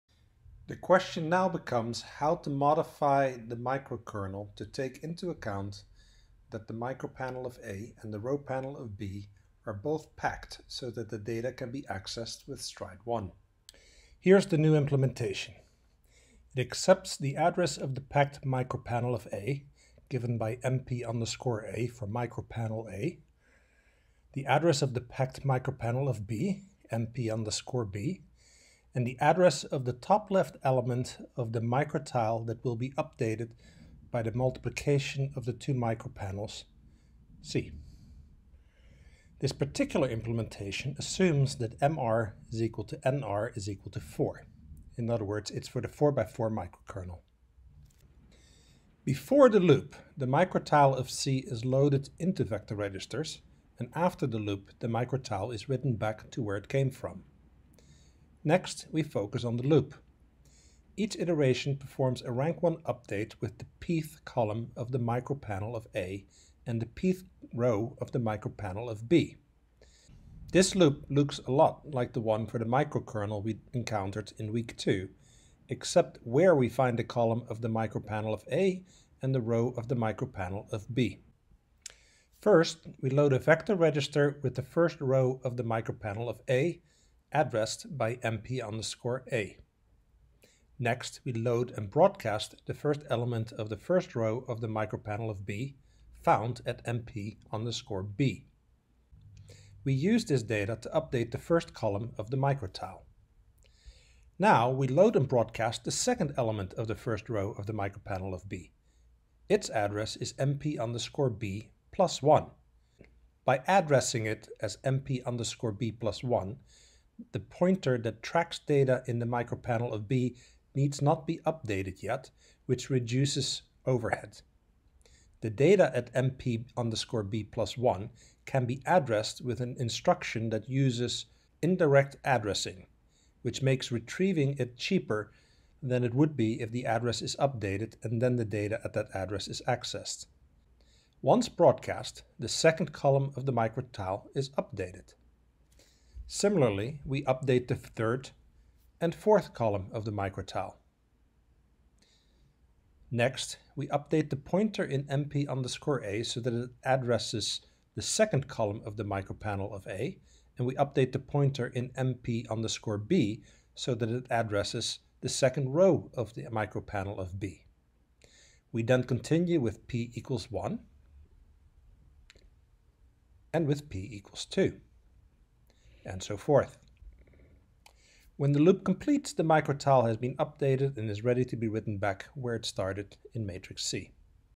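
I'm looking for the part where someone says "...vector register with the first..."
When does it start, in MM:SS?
01:23.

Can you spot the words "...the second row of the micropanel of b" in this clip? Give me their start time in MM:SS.
02:45.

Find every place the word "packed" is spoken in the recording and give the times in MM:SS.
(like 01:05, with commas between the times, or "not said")
00:10, 00:17, 00:25.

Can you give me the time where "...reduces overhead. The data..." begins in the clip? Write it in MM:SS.
02:02.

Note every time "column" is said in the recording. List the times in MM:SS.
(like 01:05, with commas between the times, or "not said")
01:04, 01:17, 01:41, 02:22, 02:29, 02:38.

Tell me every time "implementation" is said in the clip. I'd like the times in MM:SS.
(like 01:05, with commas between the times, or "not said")
00:14, 00:40.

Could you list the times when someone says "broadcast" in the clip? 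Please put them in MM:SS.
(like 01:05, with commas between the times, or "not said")
01:31, 01:45, 02:21.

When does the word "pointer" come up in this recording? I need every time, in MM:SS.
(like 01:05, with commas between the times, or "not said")
01:57, 02:34, 02:41.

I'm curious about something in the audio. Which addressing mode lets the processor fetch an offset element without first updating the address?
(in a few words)
Indirect addressing.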